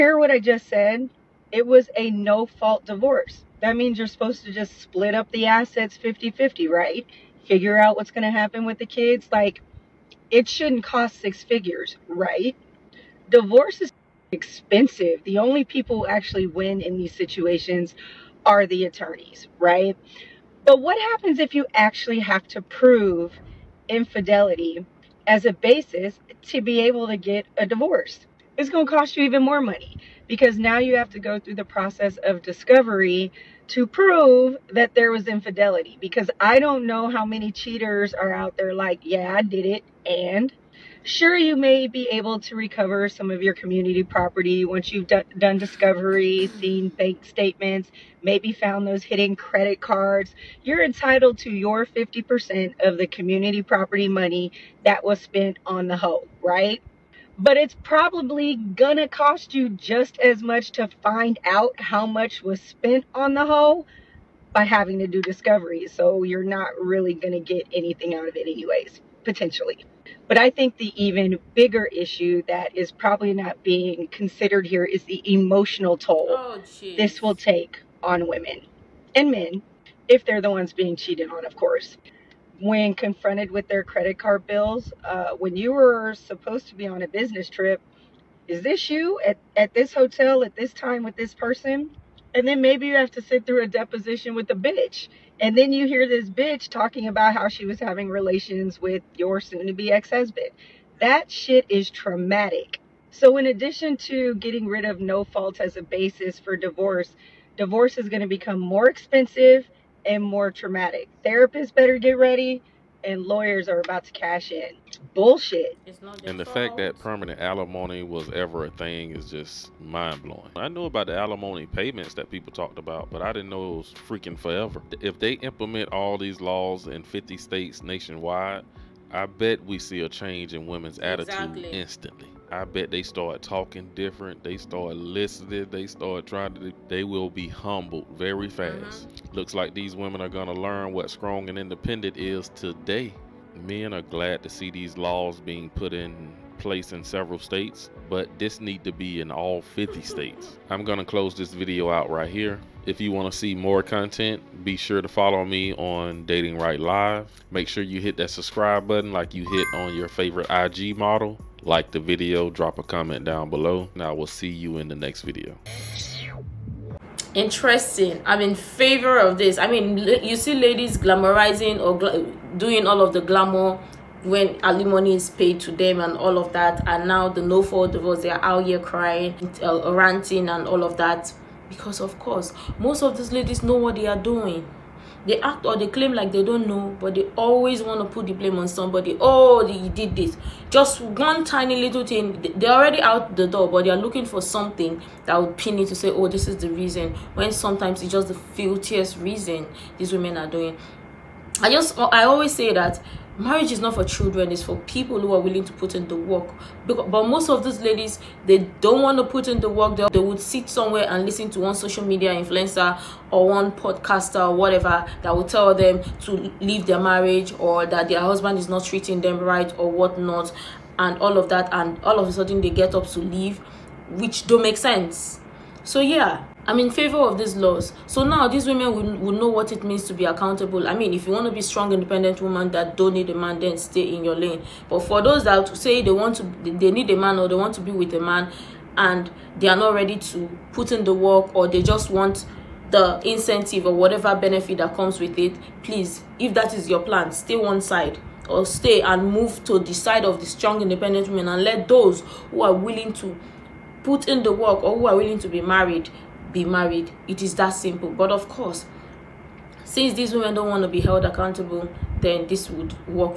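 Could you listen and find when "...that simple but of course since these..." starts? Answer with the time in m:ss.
4:17.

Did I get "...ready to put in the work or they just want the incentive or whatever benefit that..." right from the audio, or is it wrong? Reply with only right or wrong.
right.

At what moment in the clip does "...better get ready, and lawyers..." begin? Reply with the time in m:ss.
1:51.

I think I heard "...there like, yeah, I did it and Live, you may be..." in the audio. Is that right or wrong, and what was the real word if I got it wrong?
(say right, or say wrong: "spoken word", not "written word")
wrong: "Sure", not "Live".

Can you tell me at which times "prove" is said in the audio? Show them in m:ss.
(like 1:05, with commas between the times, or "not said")
0:22, 0:33.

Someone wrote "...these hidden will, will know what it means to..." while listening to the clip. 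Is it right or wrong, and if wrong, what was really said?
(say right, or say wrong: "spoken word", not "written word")
wrong: "women", not "hidden".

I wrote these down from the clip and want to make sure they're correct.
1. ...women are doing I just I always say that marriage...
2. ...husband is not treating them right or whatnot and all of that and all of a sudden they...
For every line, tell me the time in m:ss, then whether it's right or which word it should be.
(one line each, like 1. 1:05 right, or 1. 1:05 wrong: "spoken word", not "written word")
1. 3:20 right
2. 3:38 right.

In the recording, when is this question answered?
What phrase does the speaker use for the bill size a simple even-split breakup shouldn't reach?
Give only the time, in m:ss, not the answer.
0:11.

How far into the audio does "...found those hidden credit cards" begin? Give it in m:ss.
0:48.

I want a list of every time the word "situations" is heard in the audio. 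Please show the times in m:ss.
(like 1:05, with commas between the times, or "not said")
0:17.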